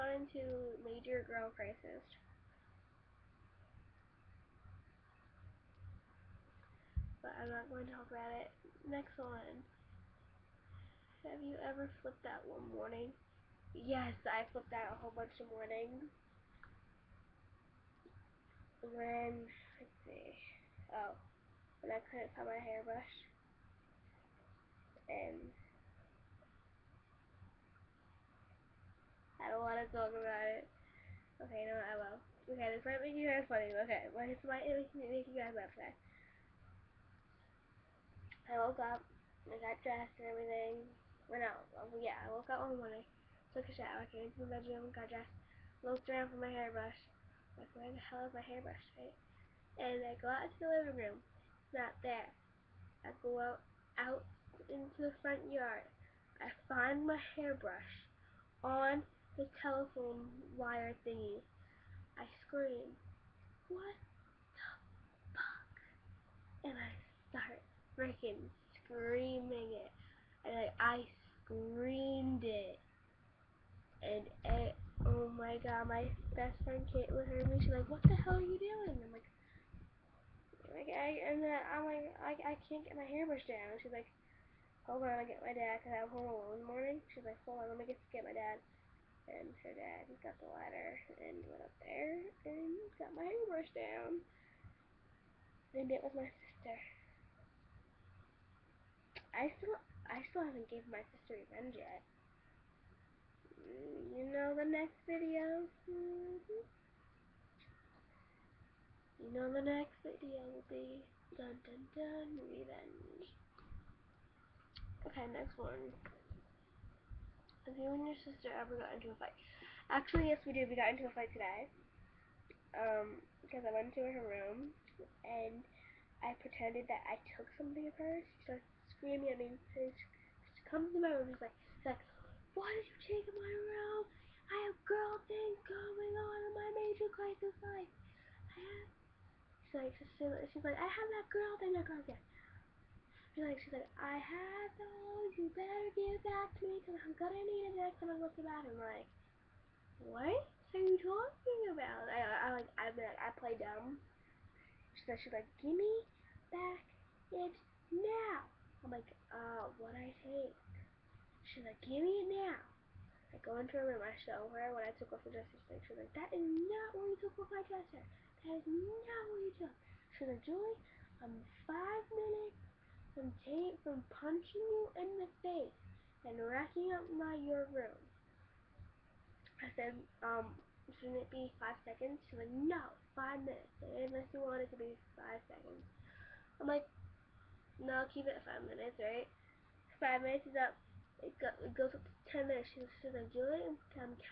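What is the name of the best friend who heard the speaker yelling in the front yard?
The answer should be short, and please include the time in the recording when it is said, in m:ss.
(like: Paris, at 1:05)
Caitlin, at 1:16.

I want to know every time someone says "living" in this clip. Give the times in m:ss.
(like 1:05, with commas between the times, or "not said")
0:50.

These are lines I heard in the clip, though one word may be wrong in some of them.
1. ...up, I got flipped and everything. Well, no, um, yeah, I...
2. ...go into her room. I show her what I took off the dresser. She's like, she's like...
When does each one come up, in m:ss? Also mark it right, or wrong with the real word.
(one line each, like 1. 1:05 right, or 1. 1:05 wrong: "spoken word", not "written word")
1. 0:38 wrong: "dressed", not "flipped"
2. 2:43 right.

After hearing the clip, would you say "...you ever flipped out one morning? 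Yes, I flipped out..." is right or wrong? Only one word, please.
right.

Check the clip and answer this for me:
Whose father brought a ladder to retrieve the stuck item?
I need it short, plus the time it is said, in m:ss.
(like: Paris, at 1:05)
Caitlin's, at 1:29.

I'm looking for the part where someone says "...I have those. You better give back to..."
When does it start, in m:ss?
2:23.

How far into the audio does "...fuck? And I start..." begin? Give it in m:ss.
1:05.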